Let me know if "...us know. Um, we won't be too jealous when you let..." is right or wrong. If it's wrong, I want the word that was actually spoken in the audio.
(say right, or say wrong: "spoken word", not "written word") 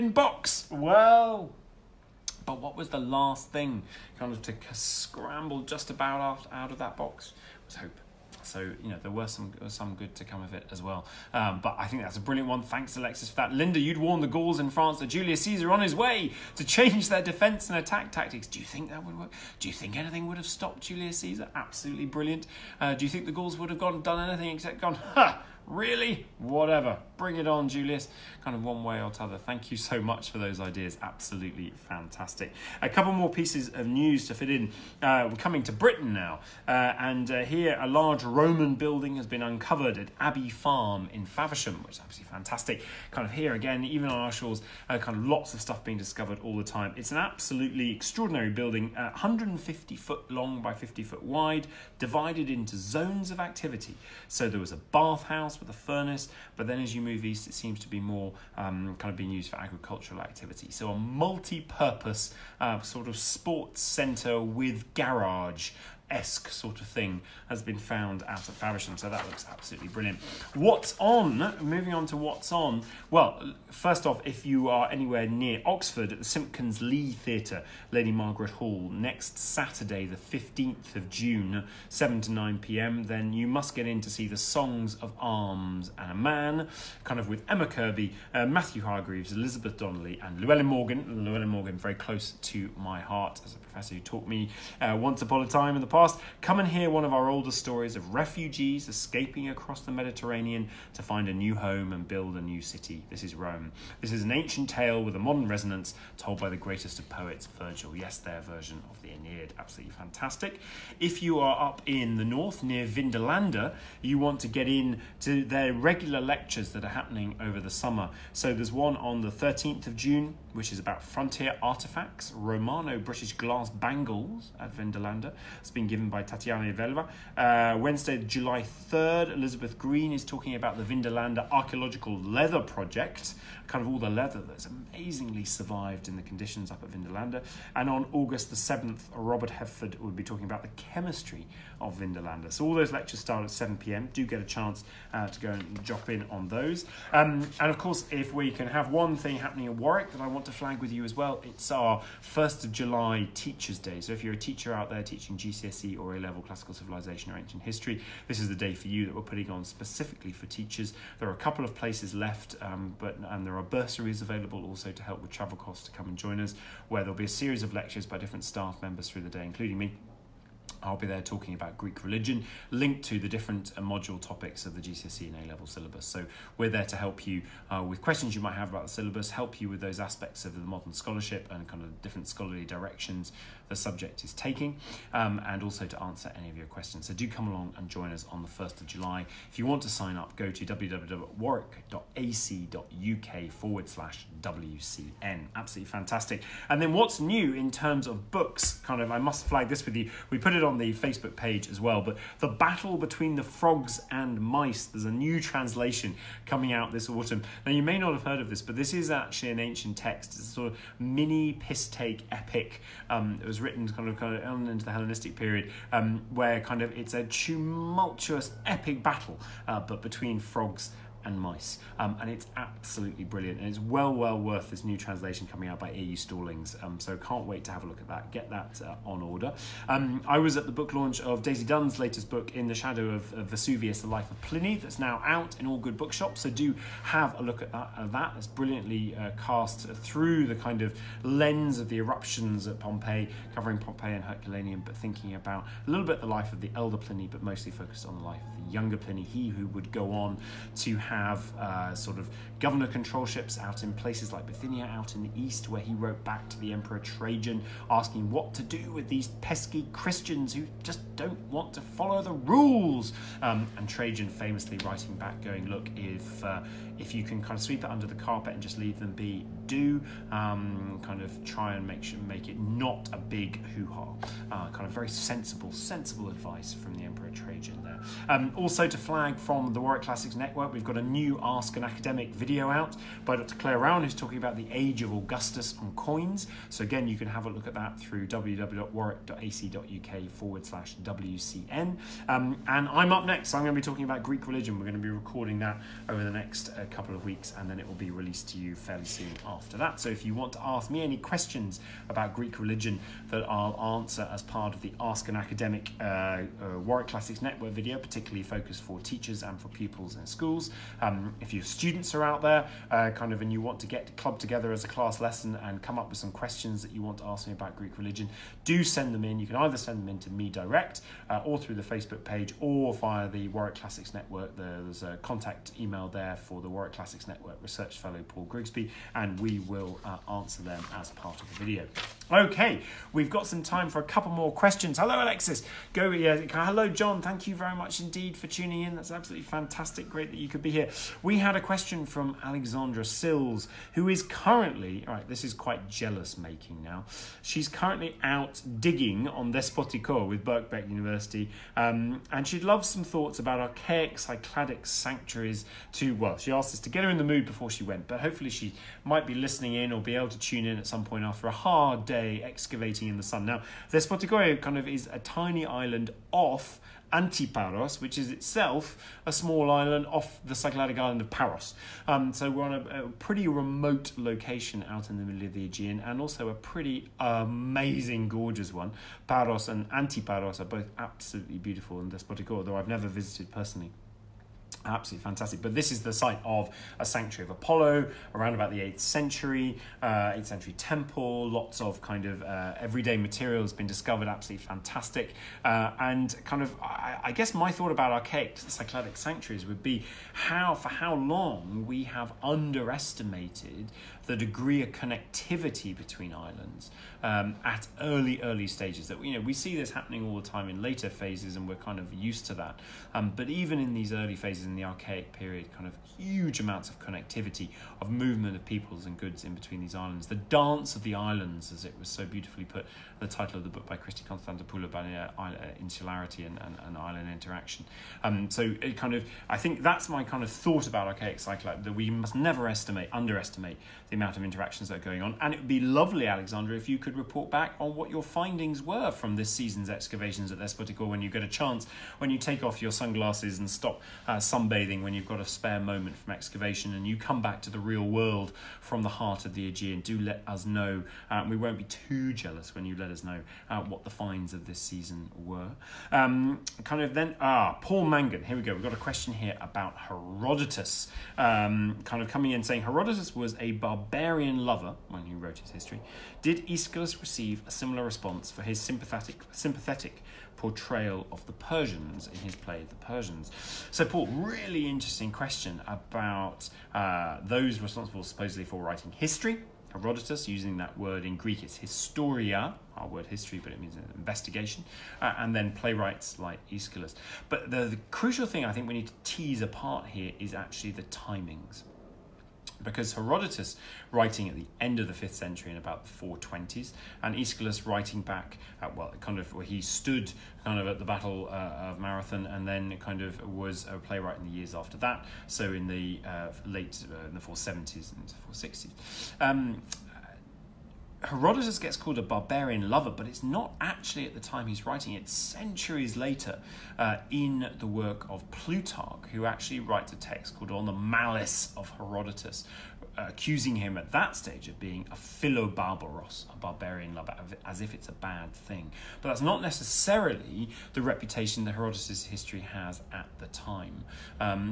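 right.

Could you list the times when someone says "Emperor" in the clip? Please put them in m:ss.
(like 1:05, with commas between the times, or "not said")
4:16, 4:37.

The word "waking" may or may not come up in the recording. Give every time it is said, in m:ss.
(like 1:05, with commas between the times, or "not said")
not said.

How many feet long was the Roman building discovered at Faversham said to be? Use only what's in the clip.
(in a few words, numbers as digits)
150.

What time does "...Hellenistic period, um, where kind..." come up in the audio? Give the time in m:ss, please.
3:34.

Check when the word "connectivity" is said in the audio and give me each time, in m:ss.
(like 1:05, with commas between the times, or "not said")
6:44, 6:56.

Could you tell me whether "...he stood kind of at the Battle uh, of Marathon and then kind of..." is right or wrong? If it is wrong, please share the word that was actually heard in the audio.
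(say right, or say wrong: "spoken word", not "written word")
right.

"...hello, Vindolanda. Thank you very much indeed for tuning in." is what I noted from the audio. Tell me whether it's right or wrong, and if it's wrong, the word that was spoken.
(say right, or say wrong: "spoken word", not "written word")
wrong: "John", not "Vindolanda".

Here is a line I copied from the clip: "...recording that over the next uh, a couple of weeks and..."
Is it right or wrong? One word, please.
right.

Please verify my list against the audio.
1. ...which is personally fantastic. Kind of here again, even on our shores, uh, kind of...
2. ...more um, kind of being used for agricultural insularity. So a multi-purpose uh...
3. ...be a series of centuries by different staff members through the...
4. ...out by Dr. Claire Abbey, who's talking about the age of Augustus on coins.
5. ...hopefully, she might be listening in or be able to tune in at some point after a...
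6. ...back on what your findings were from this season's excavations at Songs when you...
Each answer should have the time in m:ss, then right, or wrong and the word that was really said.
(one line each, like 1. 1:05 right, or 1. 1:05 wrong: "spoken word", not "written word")
1. 0:41 wrong: "absolutely", not "personally"
2. 0:57 wrong: "activity", not "insularity"
3. 2:47 wrong: "lectures", not "centuries"
4. 4:42 wrong: "Rowan", not "Abbey"
5. 5:58 right
6. 7:17 wrong: "Despotiko", not "Songs".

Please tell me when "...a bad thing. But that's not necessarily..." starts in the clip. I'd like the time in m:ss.
8:48.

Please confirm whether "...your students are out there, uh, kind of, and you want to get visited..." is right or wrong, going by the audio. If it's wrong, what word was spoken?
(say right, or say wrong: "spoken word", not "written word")
wrong: "clubbed", not "visited".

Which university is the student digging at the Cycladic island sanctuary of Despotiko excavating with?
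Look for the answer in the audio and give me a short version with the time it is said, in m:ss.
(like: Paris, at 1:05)
Birkbeck University, at 5:50.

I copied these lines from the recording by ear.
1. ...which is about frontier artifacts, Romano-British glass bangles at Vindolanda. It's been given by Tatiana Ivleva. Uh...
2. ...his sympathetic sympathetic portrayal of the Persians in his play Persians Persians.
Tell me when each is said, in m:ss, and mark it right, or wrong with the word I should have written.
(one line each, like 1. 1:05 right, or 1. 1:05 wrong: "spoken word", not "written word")
1. 2:00 right
2. 7:48 wrong: "The", not "Persians".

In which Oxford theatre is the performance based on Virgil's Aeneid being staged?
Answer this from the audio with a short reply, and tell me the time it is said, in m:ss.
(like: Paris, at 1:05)
Simpkins Lee Theatre, at 1:16.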